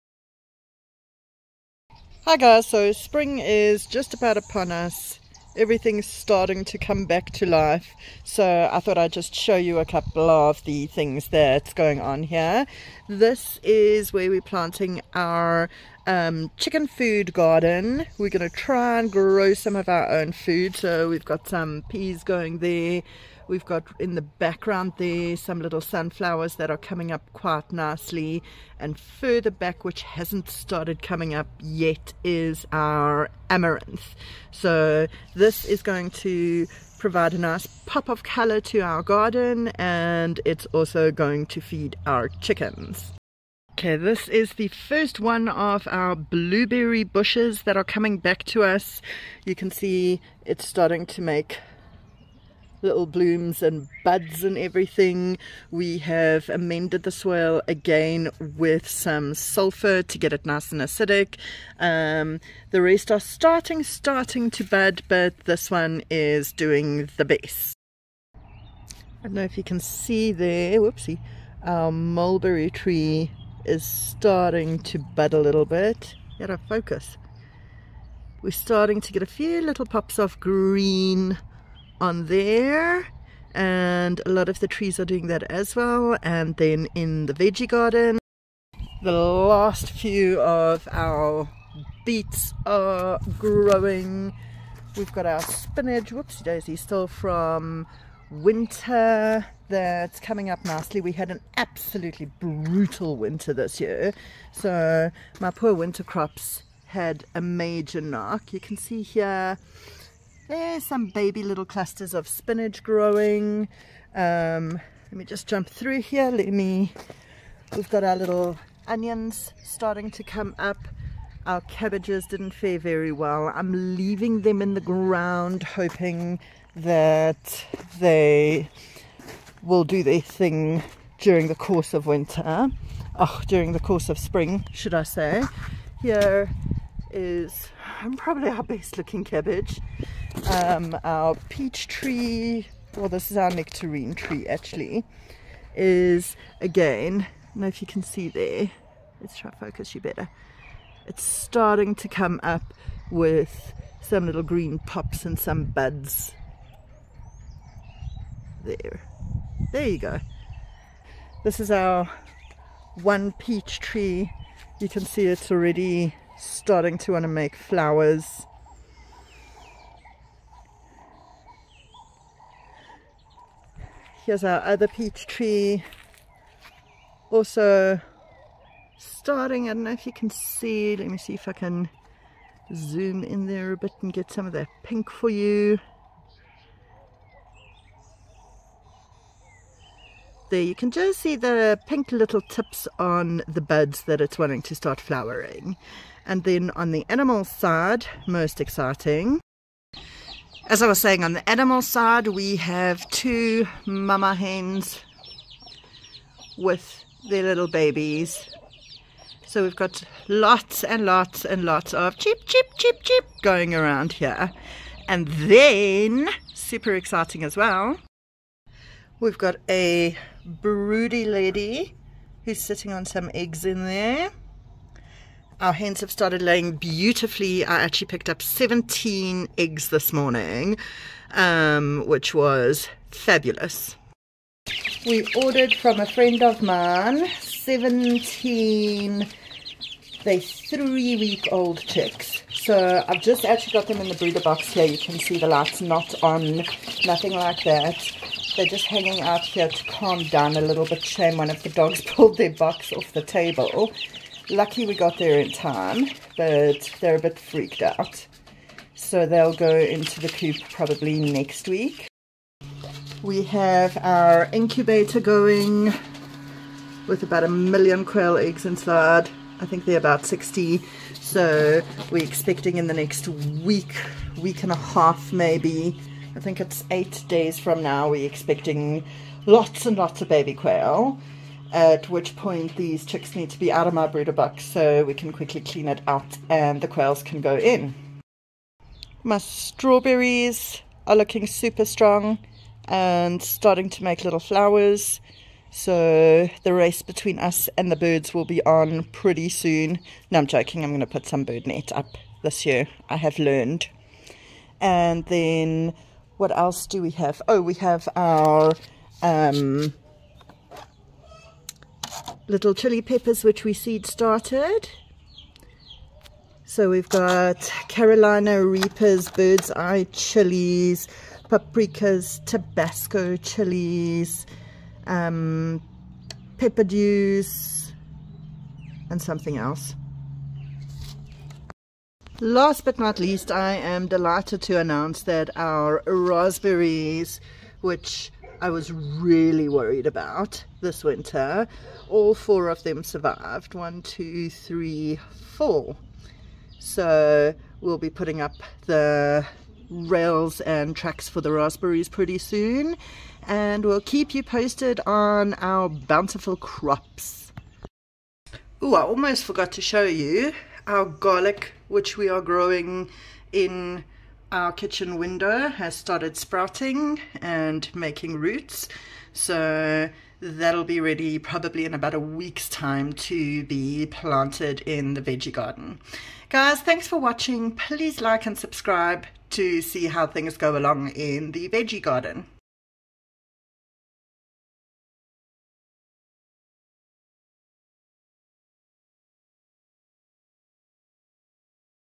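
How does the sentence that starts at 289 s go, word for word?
My strawberries are looking super strong and starting to make little flowers.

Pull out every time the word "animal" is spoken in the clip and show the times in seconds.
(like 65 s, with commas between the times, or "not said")
197 s, 201 s.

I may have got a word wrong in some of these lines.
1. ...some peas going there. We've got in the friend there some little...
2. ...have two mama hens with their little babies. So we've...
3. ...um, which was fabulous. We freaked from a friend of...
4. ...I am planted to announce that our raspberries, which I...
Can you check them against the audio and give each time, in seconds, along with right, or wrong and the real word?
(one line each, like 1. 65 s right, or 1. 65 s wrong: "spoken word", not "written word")
1. 21 s wrong: "background", not "friend"
2. 202 s right
3. 231 s wrong: "ordered", not "freaked"
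4. 333 s wrong: "delighted", not "planted".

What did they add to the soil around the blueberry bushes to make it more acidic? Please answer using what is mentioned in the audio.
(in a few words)
sulfur.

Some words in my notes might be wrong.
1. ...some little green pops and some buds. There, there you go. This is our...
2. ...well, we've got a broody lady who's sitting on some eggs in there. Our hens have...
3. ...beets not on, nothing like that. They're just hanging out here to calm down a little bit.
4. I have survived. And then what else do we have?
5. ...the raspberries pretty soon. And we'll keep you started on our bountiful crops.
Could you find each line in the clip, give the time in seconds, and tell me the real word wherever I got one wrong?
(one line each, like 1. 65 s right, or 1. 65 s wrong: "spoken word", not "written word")
1. 154 s right
2. 217 s right
3. 245 s wrong: "lights", not "beets"
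4. 303 s wrong: "learned", not "survived"
5. 351 s wrong: "posted", not "started".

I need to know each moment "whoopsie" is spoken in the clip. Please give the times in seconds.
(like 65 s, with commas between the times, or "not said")
70 s, 96 s.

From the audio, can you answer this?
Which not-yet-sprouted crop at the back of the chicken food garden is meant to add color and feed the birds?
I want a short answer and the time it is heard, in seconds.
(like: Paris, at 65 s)
amaranth, at 33 s.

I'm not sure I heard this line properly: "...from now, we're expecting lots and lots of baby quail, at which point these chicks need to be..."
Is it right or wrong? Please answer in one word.
right.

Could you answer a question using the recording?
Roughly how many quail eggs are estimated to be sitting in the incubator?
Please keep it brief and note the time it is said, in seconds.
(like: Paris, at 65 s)
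60, at 270 s.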